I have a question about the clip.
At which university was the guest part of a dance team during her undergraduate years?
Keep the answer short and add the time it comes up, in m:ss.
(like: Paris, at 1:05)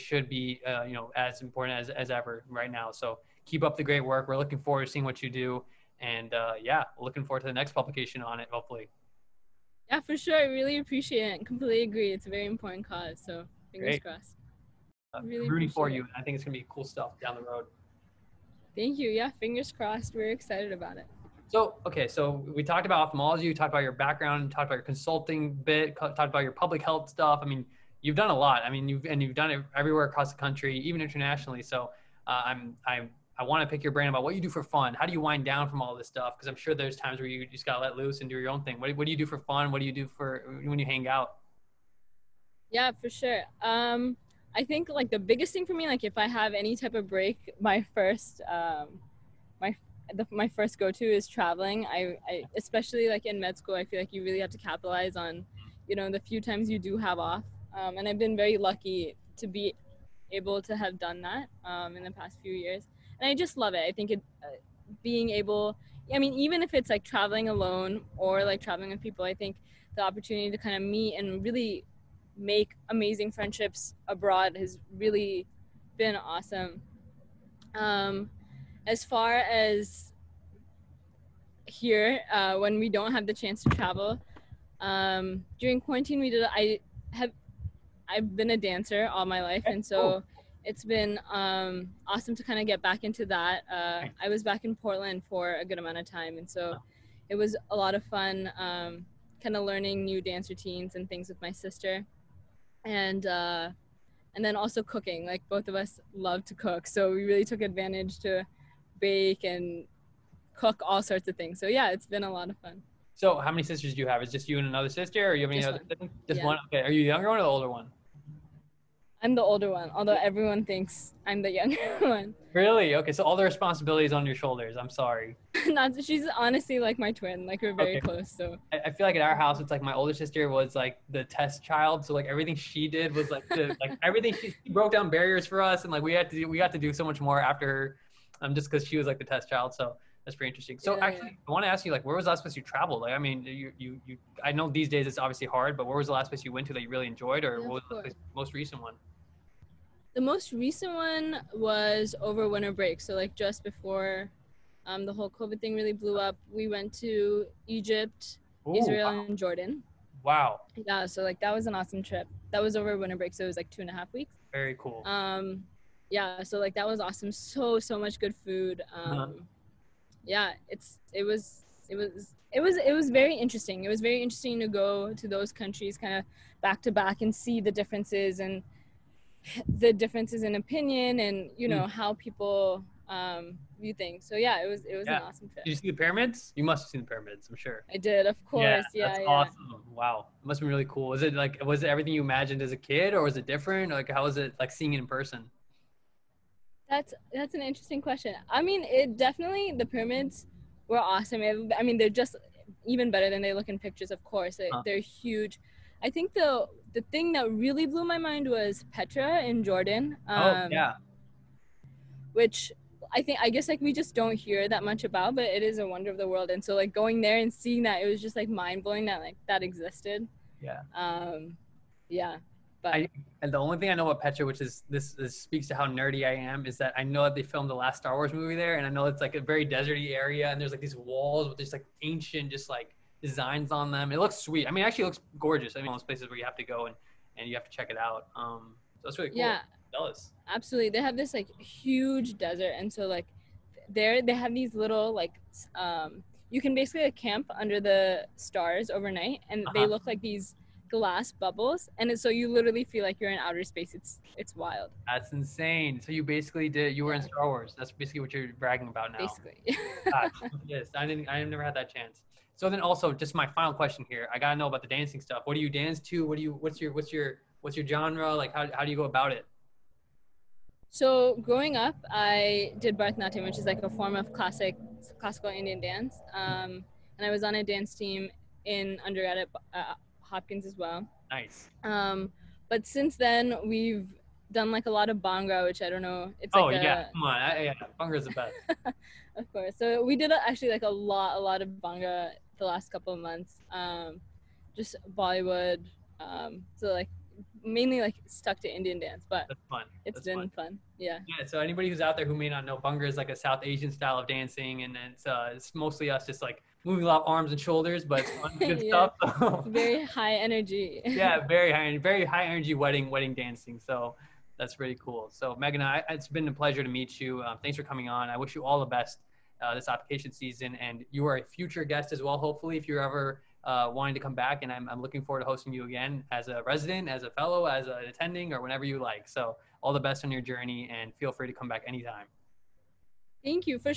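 Hopkins, at 4:40.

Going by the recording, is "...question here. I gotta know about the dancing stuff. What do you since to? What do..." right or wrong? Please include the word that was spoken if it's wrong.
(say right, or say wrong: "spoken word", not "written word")
wrong: "dance", not "since".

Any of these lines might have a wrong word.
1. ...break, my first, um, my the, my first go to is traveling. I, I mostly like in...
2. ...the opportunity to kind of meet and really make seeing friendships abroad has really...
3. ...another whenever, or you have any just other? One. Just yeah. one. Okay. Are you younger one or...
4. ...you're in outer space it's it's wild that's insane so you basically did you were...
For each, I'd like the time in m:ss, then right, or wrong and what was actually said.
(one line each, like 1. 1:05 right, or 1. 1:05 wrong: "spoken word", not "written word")
1. 0:47 wrong: "especially", not "mostly"
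2. 1:09 wrong: "amazing", not "seeing"
3. 1:54 wrong: "sister", not "whenever"
4. 4:13 right.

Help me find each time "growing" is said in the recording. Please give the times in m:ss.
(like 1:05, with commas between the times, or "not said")
4:31.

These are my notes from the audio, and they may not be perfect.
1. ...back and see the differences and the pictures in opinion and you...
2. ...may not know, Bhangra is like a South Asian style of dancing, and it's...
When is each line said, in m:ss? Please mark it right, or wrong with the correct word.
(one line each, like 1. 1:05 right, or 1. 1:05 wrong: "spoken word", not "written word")
1. 2:56 wrong: "differences", not "pictures"
2. 5:02 right.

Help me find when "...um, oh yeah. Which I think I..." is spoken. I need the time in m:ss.
3:30.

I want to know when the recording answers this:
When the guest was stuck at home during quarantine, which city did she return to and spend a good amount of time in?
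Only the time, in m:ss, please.
1:34.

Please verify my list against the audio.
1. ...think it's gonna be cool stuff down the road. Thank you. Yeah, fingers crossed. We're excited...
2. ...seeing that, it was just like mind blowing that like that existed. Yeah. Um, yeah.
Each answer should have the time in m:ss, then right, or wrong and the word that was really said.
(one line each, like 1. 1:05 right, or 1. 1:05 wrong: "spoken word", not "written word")
1. 0:16 right
2. 3:37 right.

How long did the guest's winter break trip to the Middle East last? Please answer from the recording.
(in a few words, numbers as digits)
2.5 weeks.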